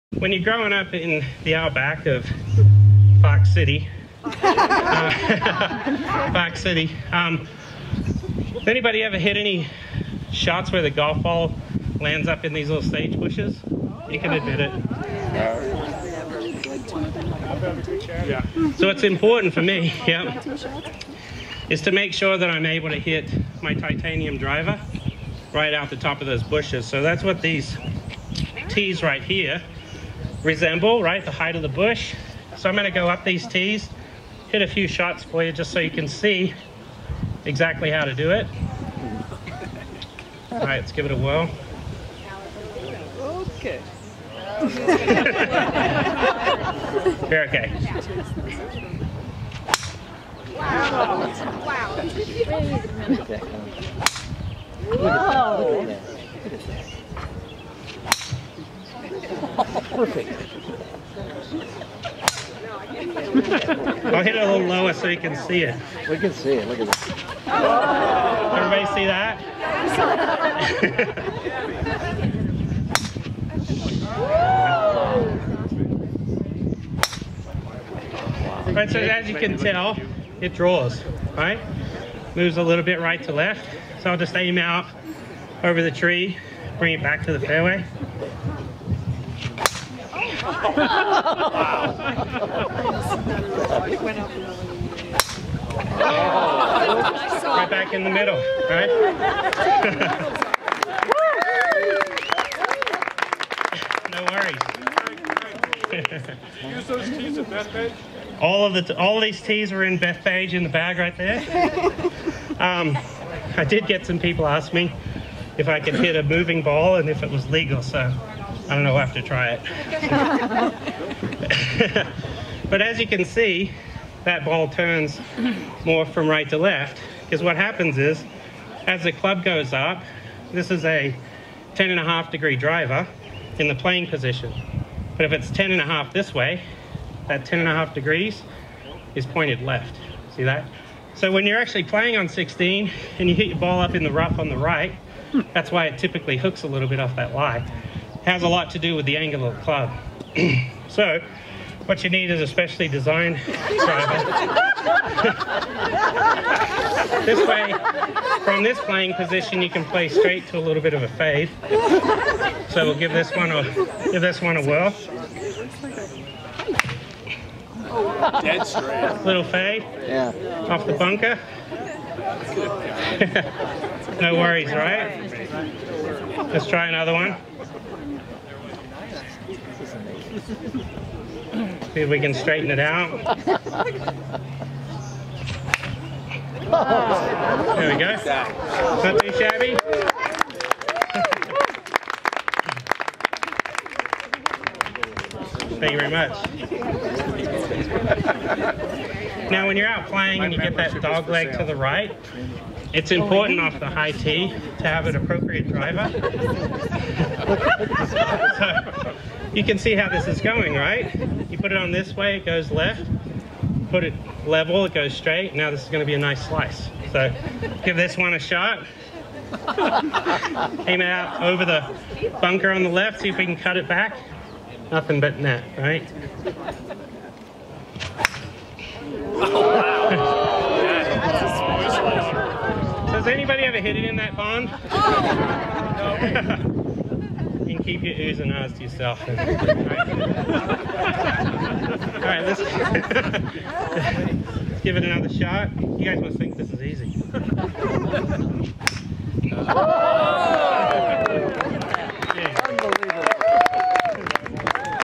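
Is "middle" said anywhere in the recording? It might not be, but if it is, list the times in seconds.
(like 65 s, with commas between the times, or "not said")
98 s.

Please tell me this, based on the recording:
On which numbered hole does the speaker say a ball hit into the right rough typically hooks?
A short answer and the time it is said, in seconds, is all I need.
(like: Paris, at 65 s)
16, at 142 s.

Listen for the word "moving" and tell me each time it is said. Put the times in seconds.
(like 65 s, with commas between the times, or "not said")
116 s.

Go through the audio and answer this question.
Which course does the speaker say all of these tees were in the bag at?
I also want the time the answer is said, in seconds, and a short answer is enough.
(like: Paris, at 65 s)
Bethpage, at 109 s.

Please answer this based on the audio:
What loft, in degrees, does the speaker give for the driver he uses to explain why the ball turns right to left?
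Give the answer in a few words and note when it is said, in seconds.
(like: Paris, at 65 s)
10.5 degrees, at 131 s.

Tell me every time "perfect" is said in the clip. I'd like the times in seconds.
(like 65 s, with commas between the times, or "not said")
60 s.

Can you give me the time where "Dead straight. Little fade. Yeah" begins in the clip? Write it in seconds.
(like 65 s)
168 s.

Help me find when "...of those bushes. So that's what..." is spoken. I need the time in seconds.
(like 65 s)
26 s.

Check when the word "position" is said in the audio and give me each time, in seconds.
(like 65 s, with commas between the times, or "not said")
134 s, 159 s.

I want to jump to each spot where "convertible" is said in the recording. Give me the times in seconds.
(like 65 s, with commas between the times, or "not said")
not said.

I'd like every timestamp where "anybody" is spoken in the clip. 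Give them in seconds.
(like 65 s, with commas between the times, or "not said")
8 s, 233 s.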